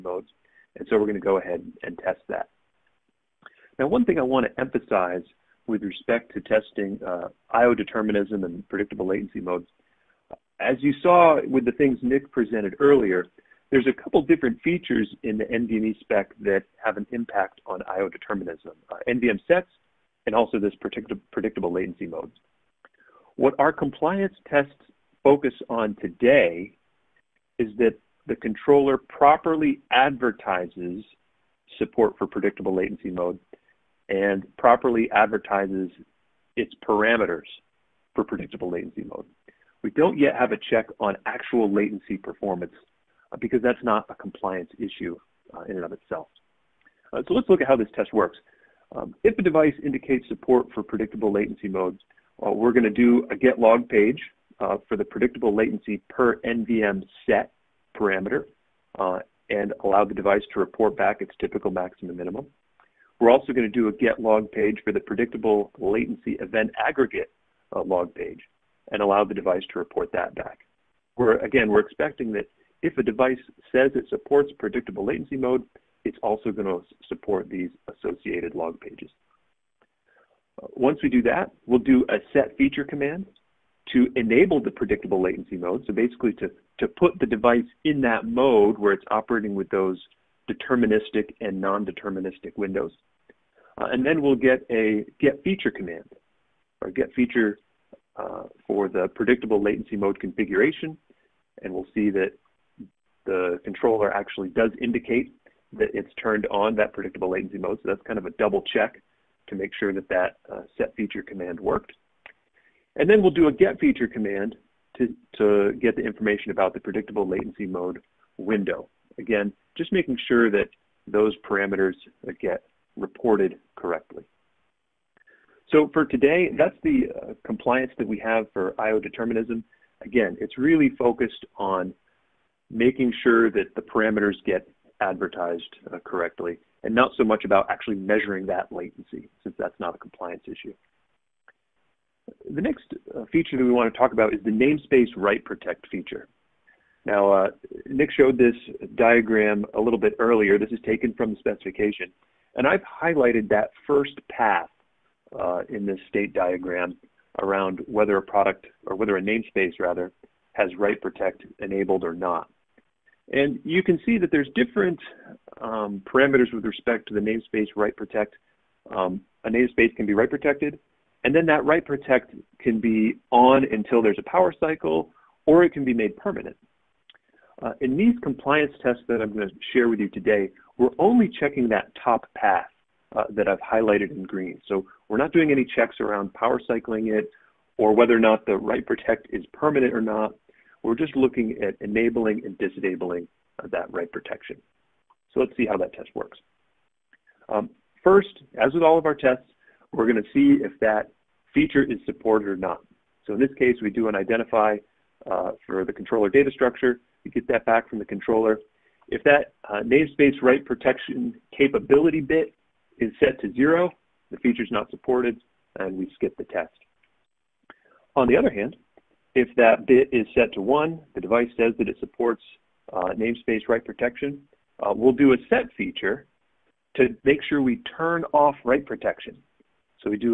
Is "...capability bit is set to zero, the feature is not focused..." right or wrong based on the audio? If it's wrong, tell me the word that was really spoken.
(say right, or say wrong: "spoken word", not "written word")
wrong: "supported", not "focused".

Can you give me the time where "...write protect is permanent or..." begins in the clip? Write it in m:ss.
3:08.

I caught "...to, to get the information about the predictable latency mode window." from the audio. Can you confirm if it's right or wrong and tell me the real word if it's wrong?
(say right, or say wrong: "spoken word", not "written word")
right.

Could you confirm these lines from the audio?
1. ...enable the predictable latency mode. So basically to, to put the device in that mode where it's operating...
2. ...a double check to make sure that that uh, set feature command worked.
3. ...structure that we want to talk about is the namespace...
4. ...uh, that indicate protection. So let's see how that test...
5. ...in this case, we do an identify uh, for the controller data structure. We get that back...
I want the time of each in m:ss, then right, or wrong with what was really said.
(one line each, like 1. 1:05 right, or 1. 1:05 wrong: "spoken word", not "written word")
1. 1:24 right
2. 1:48 right
3. 2:23 wrong: "feature", not "structure"
4. 3:13 wrong: "write", not "indicate"
5. 3:23 right.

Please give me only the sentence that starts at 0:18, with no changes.
Uh, NVM sets and also this predictable, predictable latency mode.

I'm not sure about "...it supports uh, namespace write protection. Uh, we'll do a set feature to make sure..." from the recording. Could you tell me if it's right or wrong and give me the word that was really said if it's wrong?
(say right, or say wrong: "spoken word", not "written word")
right.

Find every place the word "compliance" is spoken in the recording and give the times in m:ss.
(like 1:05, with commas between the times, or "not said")
0:23, 0:44, 2:07, 2:19, 2:58.